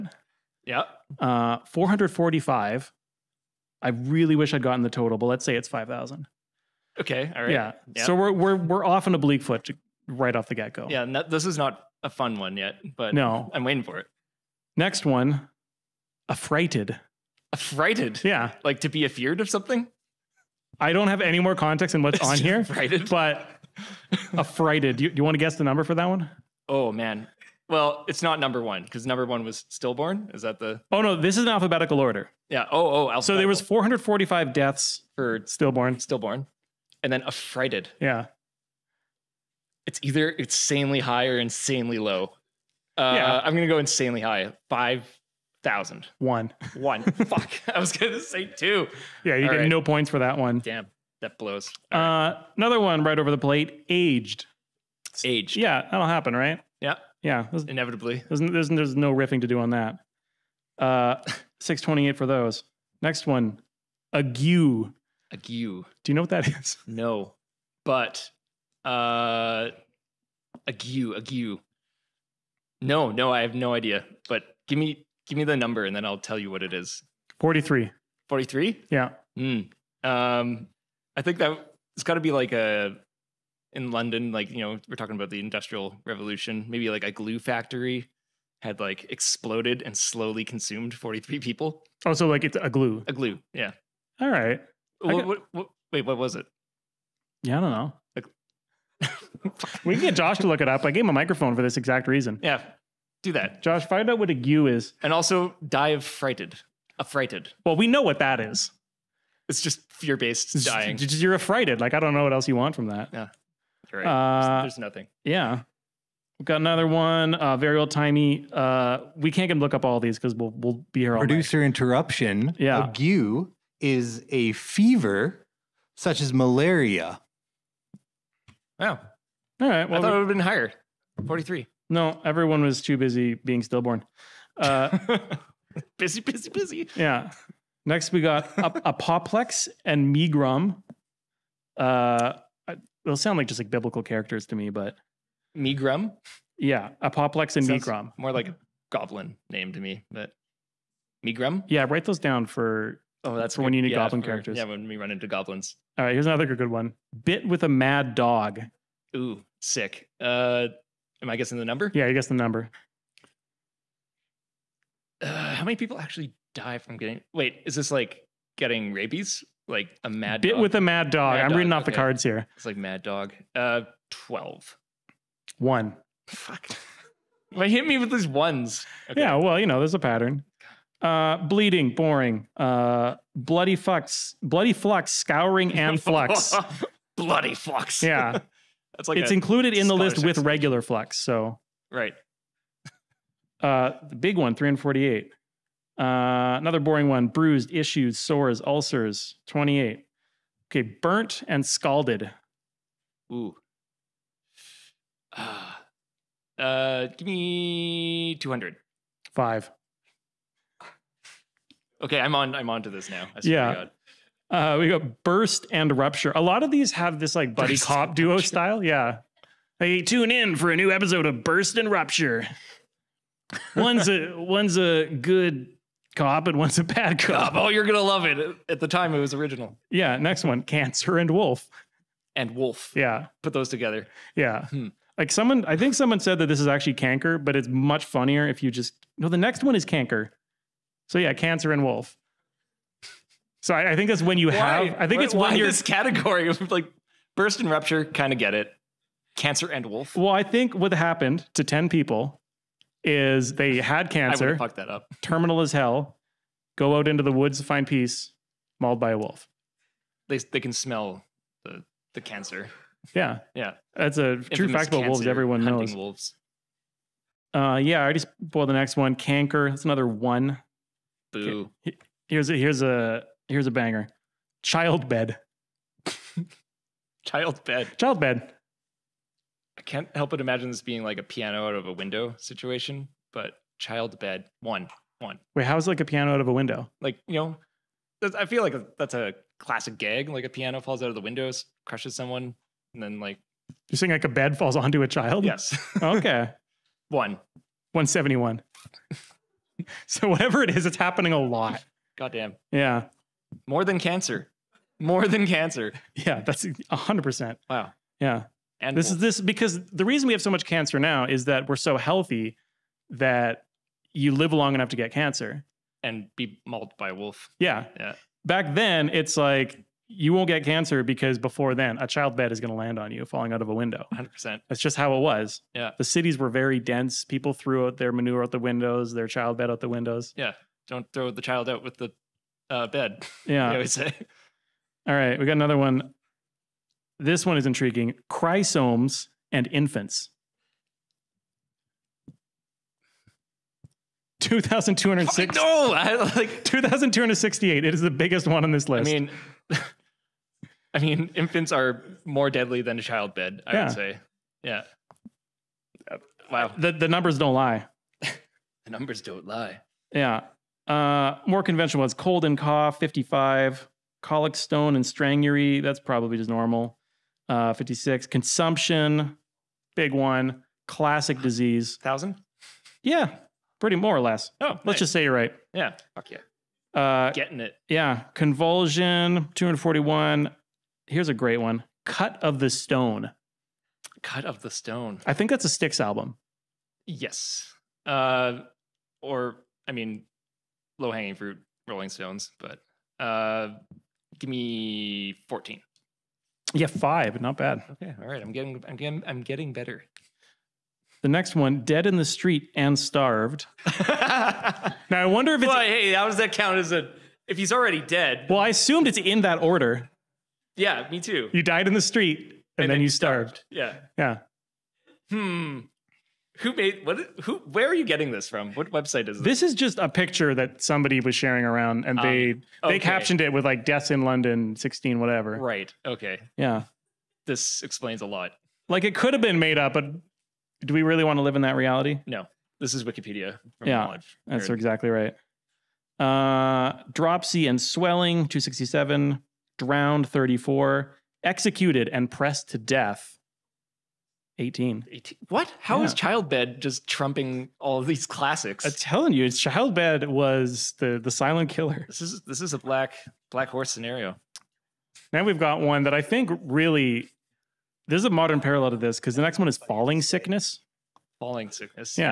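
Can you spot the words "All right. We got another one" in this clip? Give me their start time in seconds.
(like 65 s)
335 s.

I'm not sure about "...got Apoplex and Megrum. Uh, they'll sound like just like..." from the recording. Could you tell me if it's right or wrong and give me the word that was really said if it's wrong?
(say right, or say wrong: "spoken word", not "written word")
right.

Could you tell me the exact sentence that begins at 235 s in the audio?
Like someone, I think someone said that this is actually canker, but it's much funnier if you just no.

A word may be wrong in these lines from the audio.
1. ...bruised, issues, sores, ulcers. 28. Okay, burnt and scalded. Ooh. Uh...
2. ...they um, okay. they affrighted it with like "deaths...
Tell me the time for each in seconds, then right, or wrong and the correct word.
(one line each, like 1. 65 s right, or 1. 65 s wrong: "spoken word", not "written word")
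1. 197 s right
2. 422 s wrong: "captioned", not "affrighted".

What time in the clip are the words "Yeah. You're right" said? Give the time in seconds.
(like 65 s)
113 s.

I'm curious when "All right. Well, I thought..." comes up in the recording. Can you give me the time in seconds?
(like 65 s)
128 s.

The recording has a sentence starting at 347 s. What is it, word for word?
It is the biggest one on this list.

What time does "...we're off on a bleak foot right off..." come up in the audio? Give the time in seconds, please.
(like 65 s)
8 s.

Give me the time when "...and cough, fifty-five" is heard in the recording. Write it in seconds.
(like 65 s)
362 s.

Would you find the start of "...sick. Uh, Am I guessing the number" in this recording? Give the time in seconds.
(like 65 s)
159 s.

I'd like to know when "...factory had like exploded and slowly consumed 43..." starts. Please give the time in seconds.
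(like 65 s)
87 s.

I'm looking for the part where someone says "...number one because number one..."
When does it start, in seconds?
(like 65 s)
28 s.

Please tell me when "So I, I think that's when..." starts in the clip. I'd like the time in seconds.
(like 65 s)
243 s.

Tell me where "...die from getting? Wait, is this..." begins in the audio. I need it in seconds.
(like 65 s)
166 s.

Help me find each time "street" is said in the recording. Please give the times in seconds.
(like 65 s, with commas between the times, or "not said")
402 s, 411 s.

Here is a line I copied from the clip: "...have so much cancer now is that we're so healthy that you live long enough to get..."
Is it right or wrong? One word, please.
right.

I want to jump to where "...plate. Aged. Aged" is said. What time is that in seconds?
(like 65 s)
53 s.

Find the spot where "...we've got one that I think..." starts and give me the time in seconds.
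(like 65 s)
455 s.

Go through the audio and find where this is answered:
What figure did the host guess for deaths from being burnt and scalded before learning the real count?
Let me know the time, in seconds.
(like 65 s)
208 s.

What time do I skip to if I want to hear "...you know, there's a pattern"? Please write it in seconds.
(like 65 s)
179 s.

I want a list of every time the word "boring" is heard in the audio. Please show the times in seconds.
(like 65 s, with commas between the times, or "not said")
181 s, 196 s.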